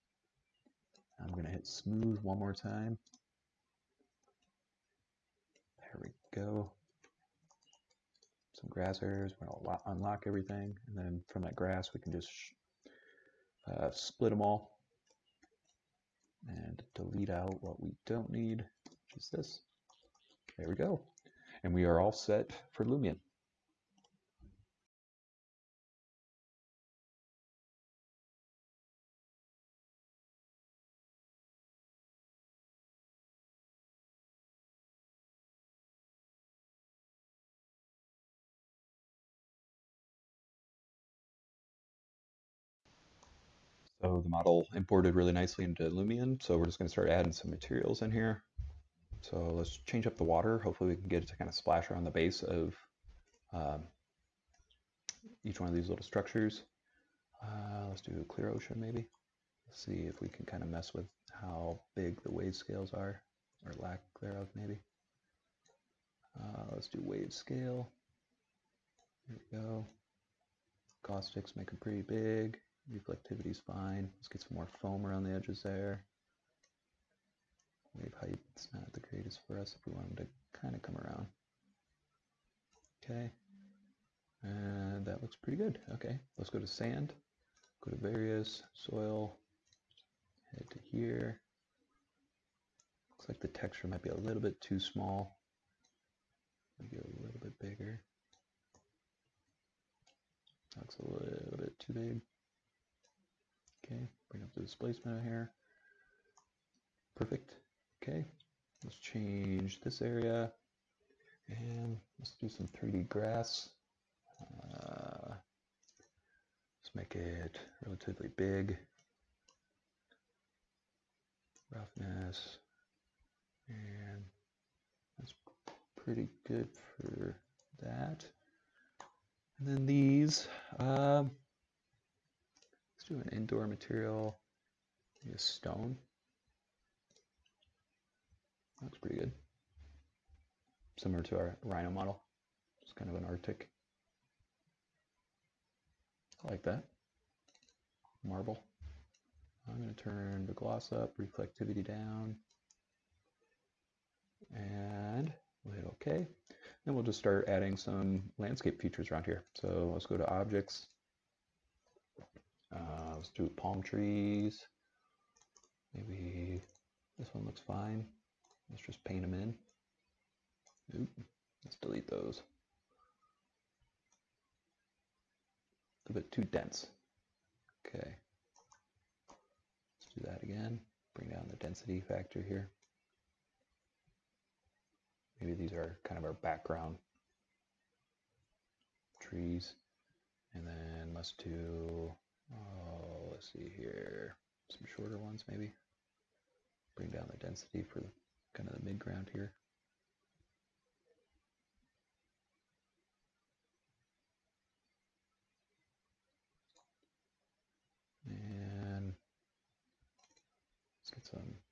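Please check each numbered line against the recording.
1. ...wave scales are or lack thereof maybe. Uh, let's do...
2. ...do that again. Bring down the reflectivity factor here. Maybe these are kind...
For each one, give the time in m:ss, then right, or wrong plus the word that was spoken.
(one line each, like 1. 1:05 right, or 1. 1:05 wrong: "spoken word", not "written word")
1. 1:02 right
2. 3:00 wrong: "density", not "reflectivity".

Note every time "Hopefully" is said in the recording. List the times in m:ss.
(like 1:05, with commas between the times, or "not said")
0:50.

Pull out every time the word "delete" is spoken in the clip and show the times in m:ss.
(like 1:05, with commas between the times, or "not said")
0:16, 2:51.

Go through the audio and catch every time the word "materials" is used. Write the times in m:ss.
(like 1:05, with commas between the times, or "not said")
0:47, 2:13.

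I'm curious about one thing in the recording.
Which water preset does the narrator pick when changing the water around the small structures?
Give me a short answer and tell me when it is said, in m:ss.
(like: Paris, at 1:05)
Clear ocean, at 0:58.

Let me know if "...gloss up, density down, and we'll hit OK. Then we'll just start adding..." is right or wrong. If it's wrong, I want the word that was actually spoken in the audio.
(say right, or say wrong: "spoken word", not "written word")
wrong: "reflectivity", not "density".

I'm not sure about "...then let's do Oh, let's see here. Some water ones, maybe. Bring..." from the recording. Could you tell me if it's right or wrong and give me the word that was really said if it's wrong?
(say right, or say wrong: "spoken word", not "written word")
wrong: "shorter", not "water".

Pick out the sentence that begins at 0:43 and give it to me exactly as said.
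So the model imported really nicely into Lumion.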